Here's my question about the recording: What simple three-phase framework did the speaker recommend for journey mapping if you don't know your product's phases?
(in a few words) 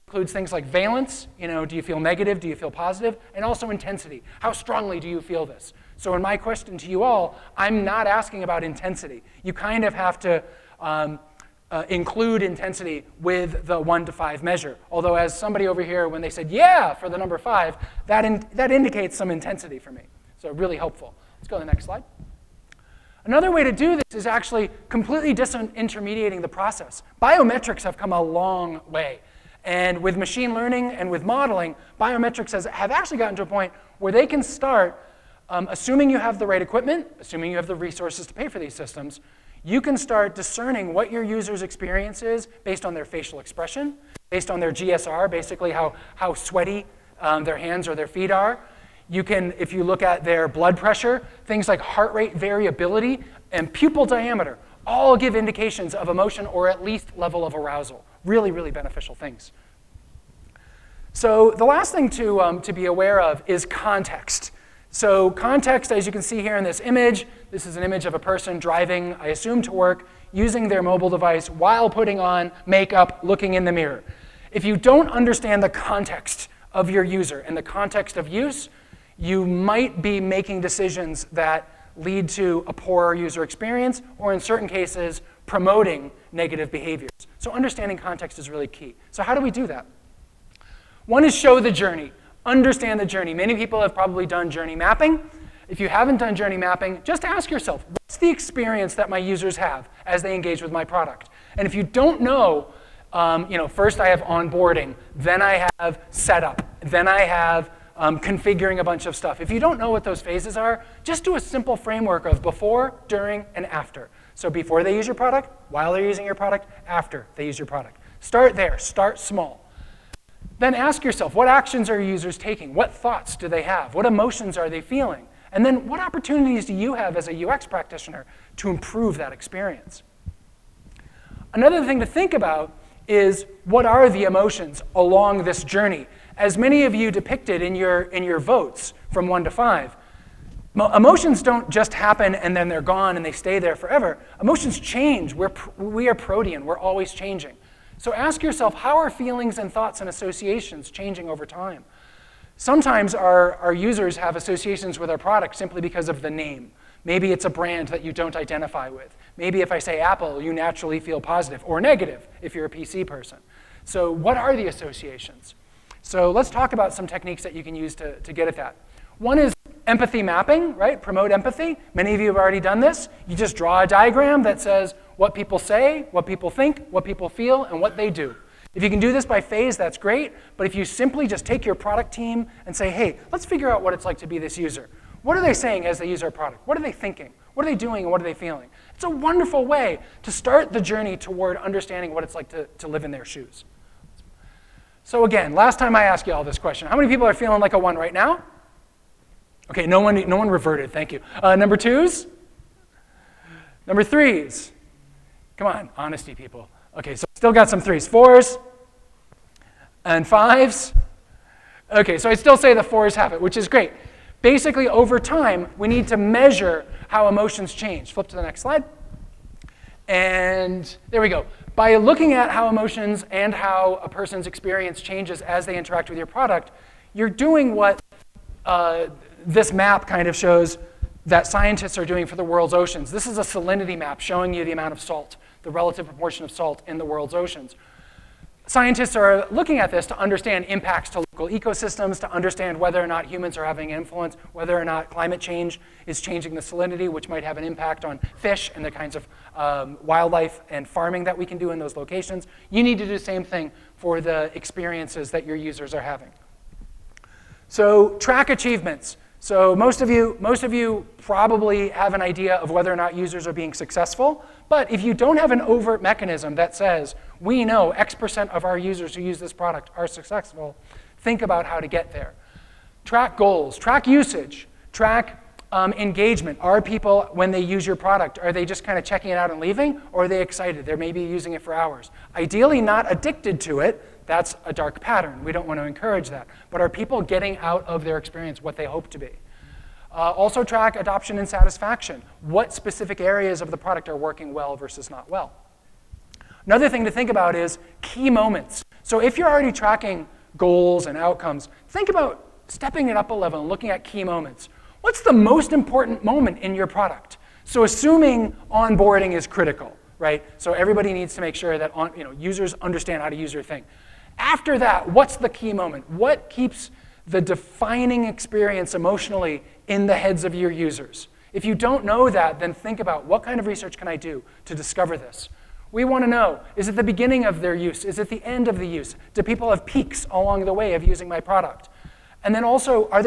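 Before, during, and after.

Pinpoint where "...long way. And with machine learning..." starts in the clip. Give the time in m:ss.
0:28.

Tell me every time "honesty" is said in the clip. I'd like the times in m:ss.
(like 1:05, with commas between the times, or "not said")
3:25.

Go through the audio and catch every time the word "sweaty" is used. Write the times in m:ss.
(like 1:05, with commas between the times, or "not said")
0:46.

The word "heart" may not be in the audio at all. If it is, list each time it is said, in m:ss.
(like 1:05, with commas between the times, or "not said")
0:51.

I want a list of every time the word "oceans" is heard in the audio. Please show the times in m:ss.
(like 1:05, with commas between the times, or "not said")
3:52, 3:57.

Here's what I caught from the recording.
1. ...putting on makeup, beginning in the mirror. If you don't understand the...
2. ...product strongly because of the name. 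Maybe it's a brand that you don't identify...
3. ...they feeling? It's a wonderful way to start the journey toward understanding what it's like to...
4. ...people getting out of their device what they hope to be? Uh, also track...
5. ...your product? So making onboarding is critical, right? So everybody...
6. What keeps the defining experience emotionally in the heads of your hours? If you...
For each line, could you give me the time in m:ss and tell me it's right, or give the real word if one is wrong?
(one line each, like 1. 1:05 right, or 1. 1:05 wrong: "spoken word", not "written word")
1. 1:11 wrong: "looking", not "beginning"
2. 2:35 wrong: "simply", not "strongly"
3. 3:08 right
4. 4:46 wrong: "experience", not "device"
5. 5:06 wrong: "assuming", not "making"
6. 5:16 wrong: "users", not "hours".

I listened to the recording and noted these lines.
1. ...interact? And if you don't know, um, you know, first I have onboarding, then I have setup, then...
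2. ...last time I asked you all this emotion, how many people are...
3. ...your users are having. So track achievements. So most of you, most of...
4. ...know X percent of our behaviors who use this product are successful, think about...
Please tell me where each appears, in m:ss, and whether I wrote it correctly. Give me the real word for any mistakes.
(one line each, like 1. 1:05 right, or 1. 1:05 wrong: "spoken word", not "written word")
1. 1:40 wrong: "product", not "interact"
2. 3:15 wrong: "question", not "emotion"
3. 4:15 right
4. 4:27 wrong: "users", not "behaviors".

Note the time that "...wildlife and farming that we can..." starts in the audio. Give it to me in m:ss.
4:10.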